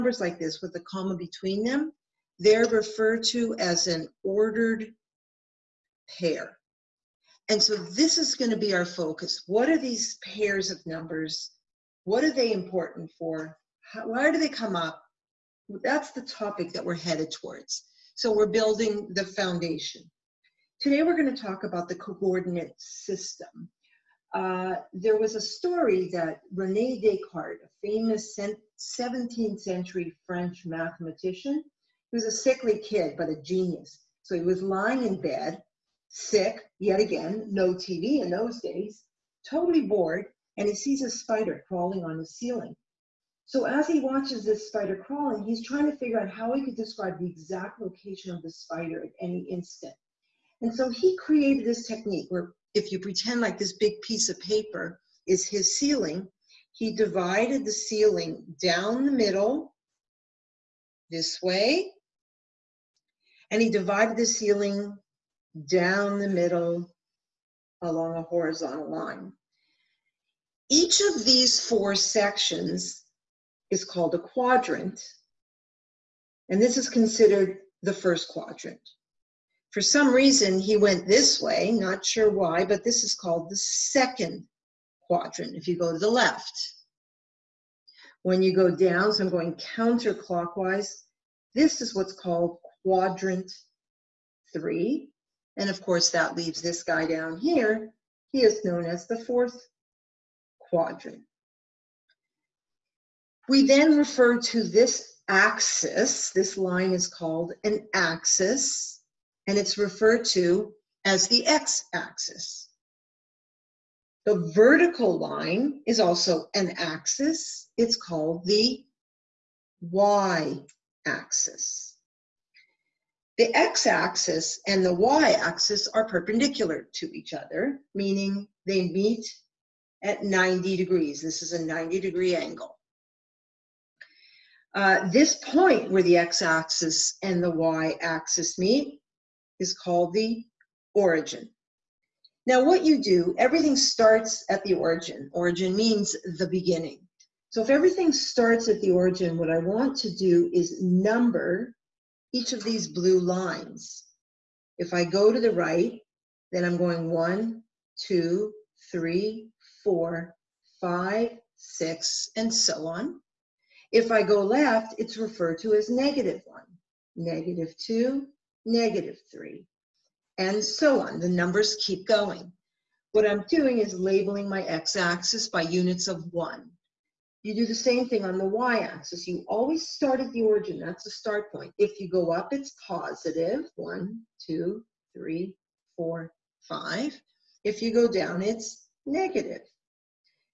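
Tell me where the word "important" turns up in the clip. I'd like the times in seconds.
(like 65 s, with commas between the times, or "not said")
12 s.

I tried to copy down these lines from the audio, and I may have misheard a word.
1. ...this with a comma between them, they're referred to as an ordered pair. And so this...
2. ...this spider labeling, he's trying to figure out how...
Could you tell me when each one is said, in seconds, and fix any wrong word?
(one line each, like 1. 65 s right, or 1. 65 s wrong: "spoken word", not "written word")
1. 0 s right
2. 44 s wrong: "crawling", not "labeling".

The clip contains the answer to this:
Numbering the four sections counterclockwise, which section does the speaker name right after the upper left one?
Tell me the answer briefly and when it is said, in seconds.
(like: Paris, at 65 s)
quadrant three, at 92 s.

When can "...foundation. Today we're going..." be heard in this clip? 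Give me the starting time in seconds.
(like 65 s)
19 s.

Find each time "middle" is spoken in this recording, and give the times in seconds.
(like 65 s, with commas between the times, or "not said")
59 s, 66 s.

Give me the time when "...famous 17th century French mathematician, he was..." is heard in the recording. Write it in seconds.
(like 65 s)
27 s.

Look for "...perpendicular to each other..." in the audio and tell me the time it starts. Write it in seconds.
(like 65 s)
126 s.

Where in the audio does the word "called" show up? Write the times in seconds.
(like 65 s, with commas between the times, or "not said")
73 s, 83 s, 92 s, 107 s, 117 s, 139 s.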